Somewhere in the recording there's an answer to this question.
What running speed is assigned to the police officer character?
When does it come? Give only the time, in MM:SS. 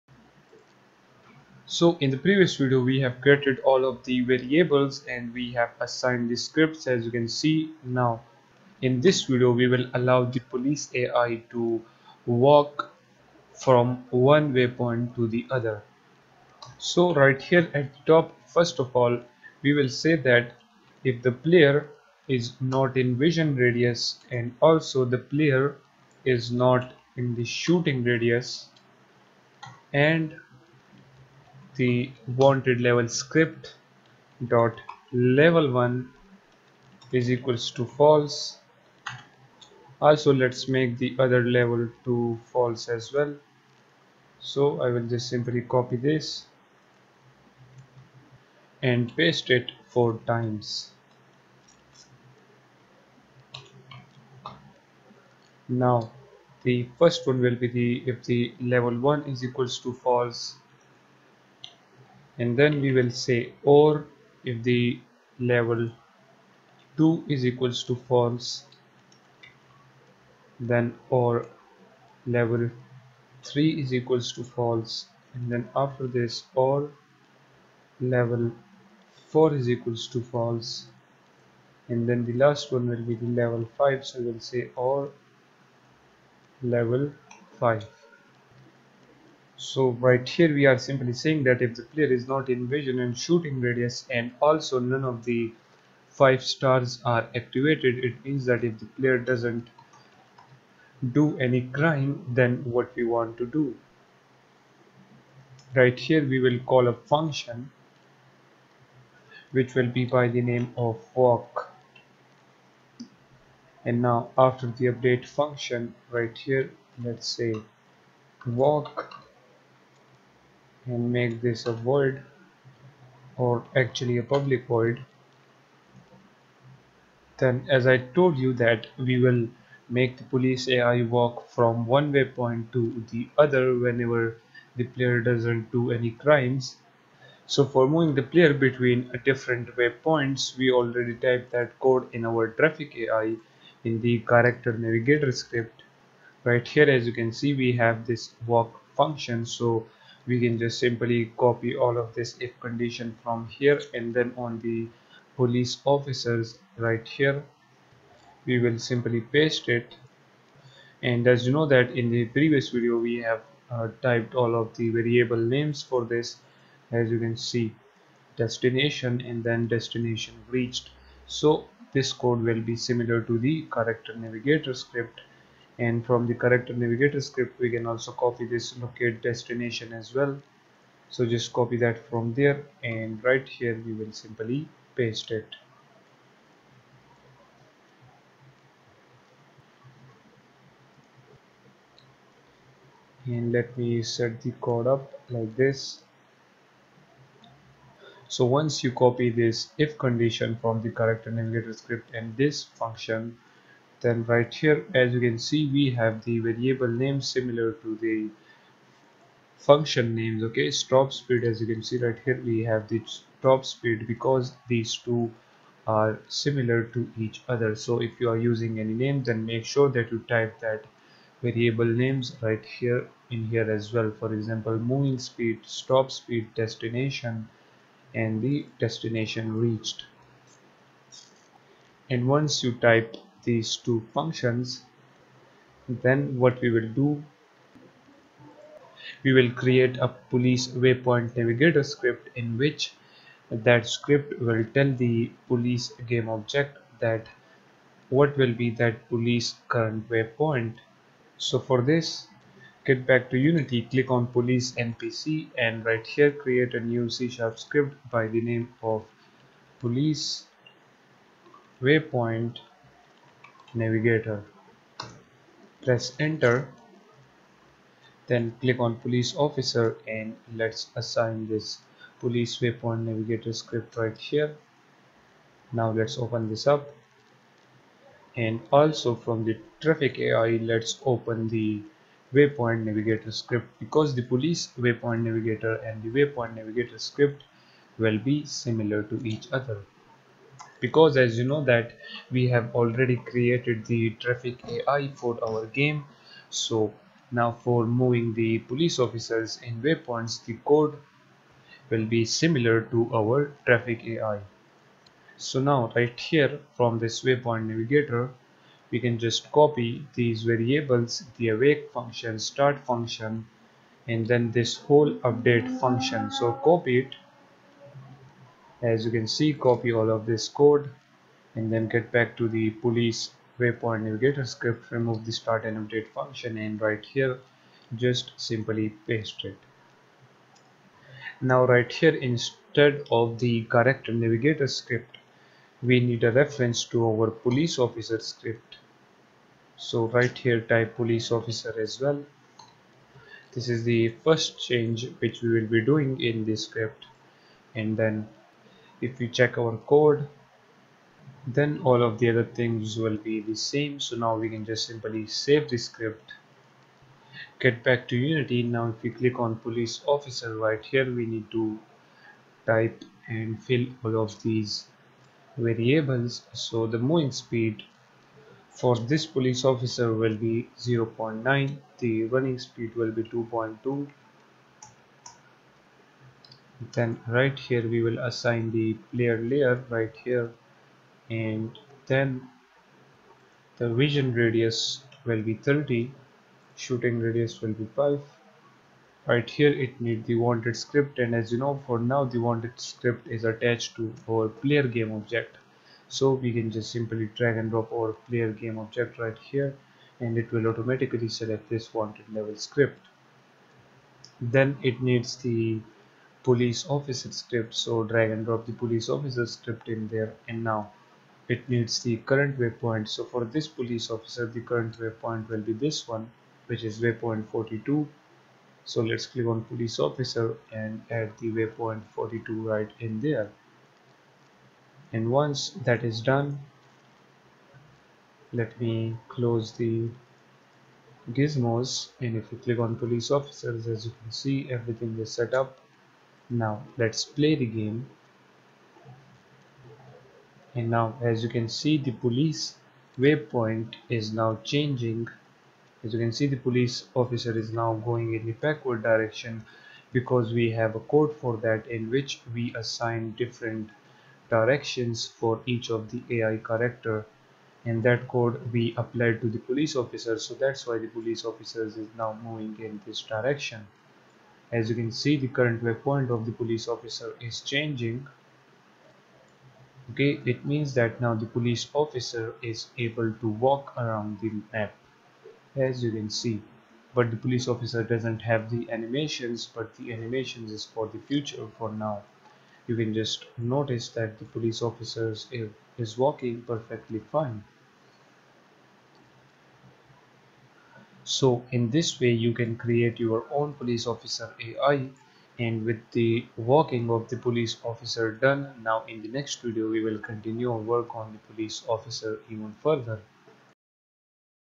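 06:13.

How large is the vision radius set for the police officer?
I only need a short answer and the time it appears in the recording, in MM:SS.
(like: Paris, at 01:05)
30, at 06:25.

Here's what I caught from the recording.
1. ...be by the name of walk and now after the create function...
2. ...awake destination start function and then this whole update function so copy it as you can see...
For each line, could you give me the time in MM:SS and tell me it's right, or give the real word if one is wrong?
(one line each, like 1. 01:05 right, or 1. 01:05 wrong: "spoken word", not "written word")
1. 01:49 wrong: "update", not "create"
2. 05:11 wrong: "function", not "destination".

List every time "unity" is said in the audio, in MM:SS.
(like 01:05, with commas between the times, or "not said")
04:13, 05:58.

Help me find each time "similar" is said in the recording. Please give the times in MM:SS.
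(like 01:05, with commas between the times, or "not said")
02:52, 03:27, 03:36, 04:48, 05:02.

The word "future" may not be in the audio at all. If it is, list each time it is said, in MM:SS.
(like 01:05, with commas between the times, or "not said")
08:01.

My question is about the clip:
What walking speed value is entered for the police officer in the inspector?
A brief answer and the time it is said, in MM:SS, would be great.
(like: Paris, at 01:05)
0.9, at 06:10.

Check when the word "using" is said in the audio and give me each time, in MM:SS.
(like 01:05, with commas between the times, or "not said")
03:38.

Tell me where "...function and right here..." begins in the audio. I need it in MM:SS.
05:26.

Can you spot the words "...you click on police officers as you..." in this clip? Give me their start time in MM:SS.
07:12.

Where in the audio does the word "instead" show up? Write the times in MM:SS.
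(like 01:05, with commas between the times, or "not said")
05:32.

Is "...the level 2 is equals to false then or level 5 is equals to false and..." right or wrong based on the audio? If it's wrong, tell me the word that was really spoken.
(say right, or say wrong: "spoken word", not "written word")
wrong: "3", not "5".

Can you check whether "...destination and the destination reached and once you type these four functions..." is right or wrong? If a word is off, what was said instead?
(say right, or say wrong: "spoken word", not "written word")
wrong: "two", not "four".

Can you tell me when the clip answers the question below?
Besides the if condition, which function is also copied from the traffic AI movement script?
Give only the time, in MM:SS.
02:58.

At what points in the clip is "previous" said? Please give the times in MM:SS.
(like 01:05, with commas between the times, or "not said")
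00:02, 02:42.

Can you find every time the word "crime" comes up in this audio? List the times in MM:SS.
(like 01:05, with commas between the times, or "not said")
01:41, 02:16.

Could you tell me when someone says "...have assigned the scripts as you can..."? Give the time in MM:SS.
00:05.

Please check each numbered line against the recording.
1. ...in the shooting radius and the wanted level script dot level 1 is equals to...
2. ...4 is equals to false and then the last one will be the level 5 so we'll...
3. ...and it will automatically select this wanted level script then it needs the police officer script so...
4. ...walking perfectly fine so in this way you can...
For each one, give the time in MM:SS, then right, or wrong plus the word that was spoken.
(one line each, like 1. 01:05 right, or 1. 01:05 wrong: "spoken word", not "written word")
1. 00:27 right
2. 01:19 right
3. 06:40 right
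4. 08:06 right.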